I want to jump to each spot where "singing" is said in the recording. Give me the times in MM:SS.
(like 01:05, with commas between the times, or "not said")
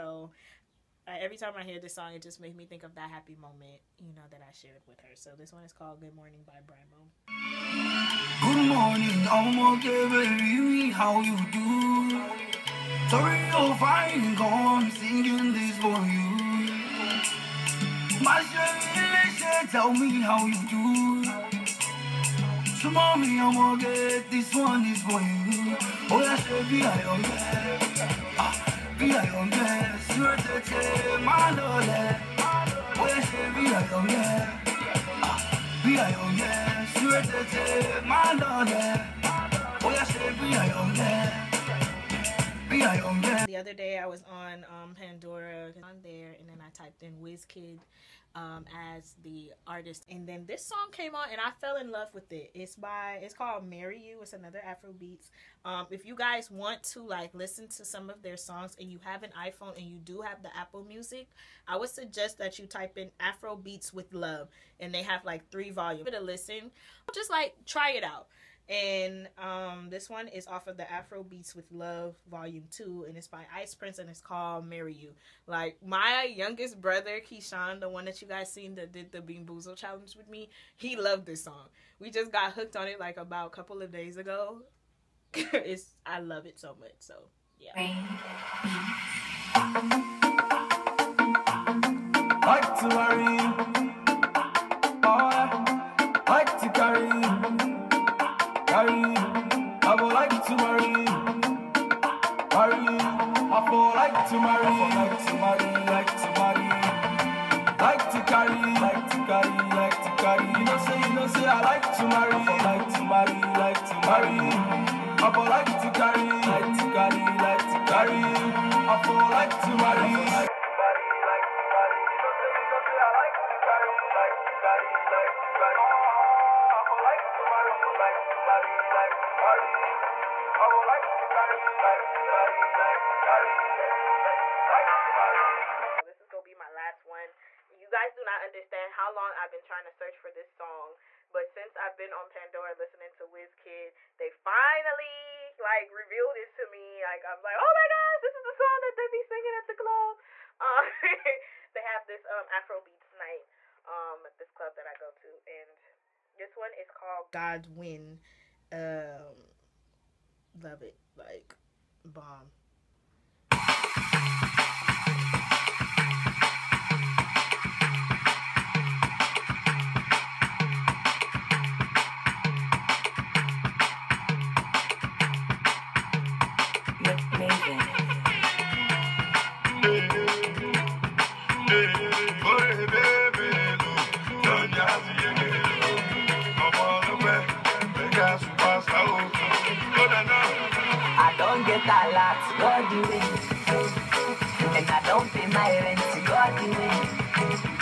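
00:14, 02:31.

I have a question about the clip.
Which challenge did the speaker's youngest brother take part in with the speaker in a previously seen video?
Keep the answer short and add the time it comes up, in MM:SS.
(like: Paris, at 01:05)
Bean Boozle challenge, at 01:19.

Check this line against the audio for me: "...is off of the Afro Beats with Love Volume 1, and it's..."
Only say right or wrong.
wrong.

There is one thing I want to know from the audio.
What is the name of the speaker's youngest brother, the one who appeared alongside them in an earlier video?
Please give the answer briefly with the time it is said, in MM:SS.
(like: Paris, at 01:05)
Keyshawn, at 01:17.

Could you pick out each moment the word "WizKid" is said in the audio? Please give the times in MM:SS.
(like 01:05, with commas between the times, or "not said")
00:47.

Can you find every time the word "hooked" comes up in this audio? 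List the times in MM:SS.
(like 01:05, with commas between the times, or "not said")
01:22.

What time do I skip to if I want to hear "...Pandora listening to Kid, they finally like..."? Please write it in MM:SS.
02:22.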